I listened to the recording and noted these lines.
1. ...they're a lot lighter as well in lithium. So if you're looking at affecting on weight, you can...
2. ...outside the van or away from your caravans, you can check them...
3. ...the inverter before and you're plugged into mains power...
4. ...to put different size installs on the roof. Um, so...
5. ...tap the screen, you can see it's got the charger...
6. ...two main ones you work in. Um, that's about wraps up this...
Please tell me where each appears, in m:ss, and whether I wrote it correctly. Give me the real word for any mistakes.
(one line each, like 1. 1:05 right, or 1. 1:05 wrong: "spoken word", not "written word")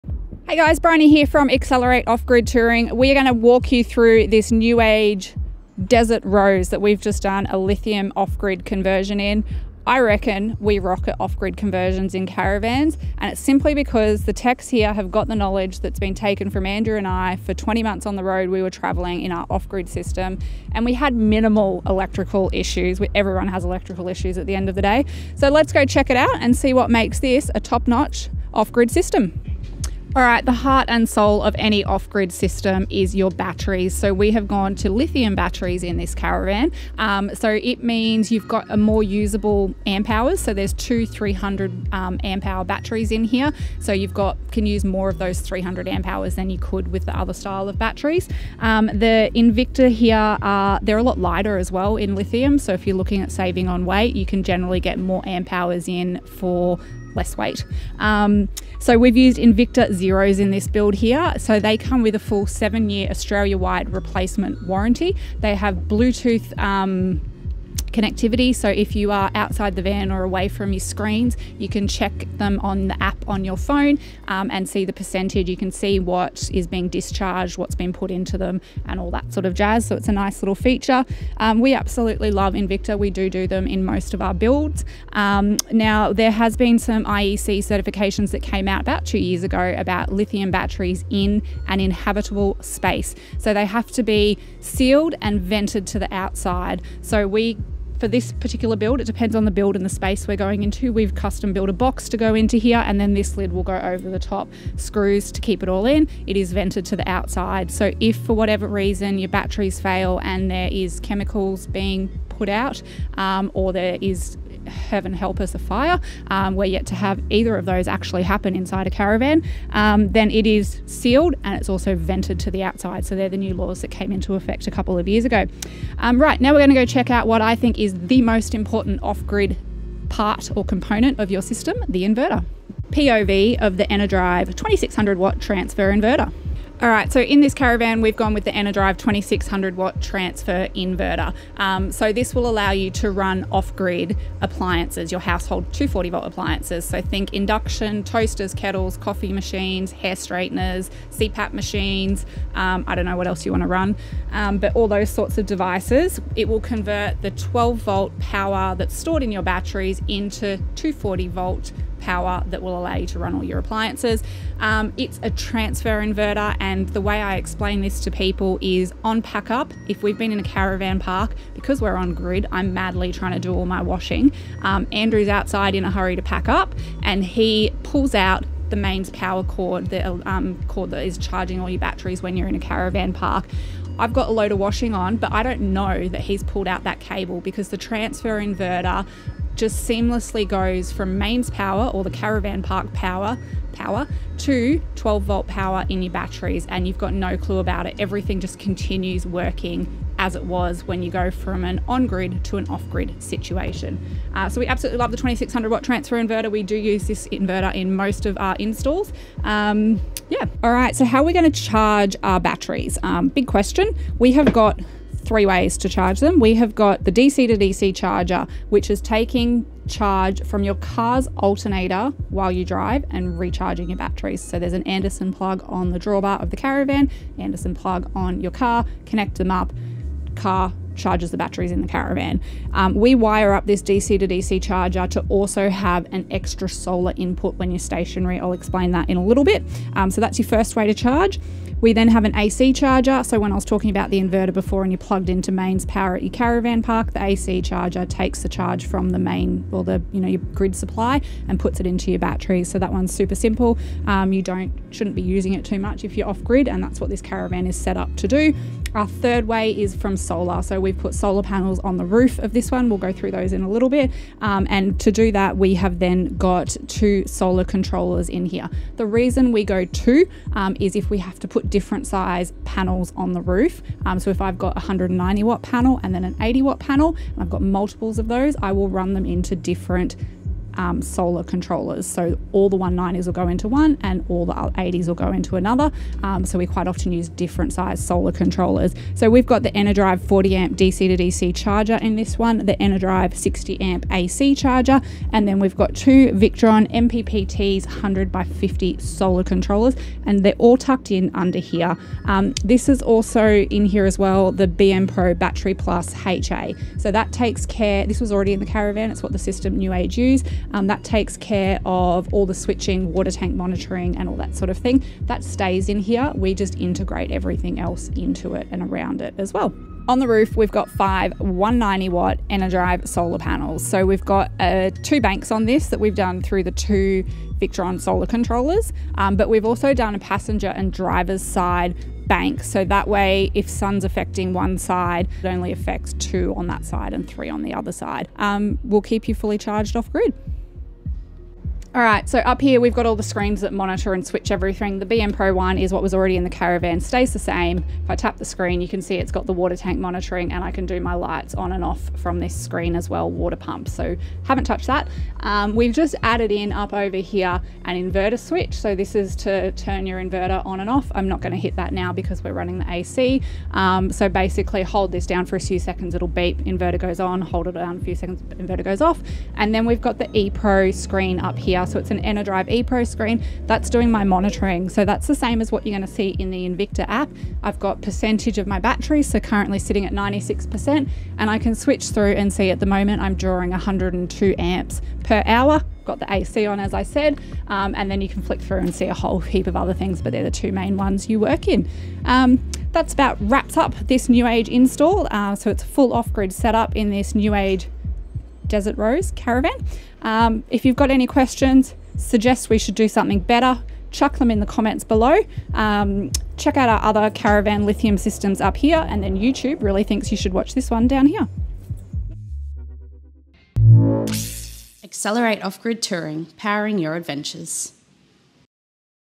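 1. 0:50 wrong: "saving", not "affecting"
2. 1:09 wrong: "screens", not "caravans"
3. 4:04 right
4. 4:31 wrong: "panels", not "installs"
5. 5:48 wrong: "water", not "charger"
6. 6:30 right.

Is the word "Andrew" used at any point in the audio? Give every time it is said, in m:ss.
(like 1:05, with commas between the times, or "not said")
0:16, 2:54.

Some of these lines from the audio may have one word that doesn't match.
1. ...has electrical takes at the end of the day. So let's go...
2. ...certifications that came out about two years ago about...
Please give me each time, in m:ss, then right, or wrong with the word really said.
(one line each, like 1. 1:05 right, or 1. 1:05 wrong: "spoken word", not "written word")
1. 0:23 wrong: "issues", not "takes"
2. 1:27 right.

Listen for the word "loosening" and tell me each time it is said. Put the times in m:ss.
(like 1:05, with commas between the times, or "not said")
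not said.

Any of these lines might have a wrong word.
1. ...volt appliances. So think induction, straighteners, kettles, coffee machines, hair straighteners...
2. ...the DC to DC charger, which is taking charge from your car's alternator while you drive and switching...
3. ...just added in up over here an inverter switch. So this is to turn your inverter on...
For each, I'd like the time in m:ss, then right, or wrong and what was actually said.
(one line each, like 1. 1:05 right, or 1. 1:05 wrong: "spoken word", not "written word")
1. 2:26 wrong: "toasters", not "straighteners"
2. 3:37 wrong: "recharging", not "switching"
3. 5:55 right.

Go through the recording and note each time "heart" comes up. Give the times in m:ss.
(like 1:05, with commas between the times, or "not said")
0:30.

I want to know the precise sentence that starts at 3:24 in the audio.
Uh, so, we absolutely love the 2600 watt transfer inverter.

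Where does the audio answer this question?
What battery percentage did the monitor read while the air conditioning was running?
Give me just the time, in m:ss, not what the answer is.
6:20.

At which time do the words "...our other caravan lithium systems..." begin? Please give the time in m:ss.
6:46.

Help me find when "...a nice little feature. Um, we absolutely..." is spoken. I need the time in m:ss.
1:20.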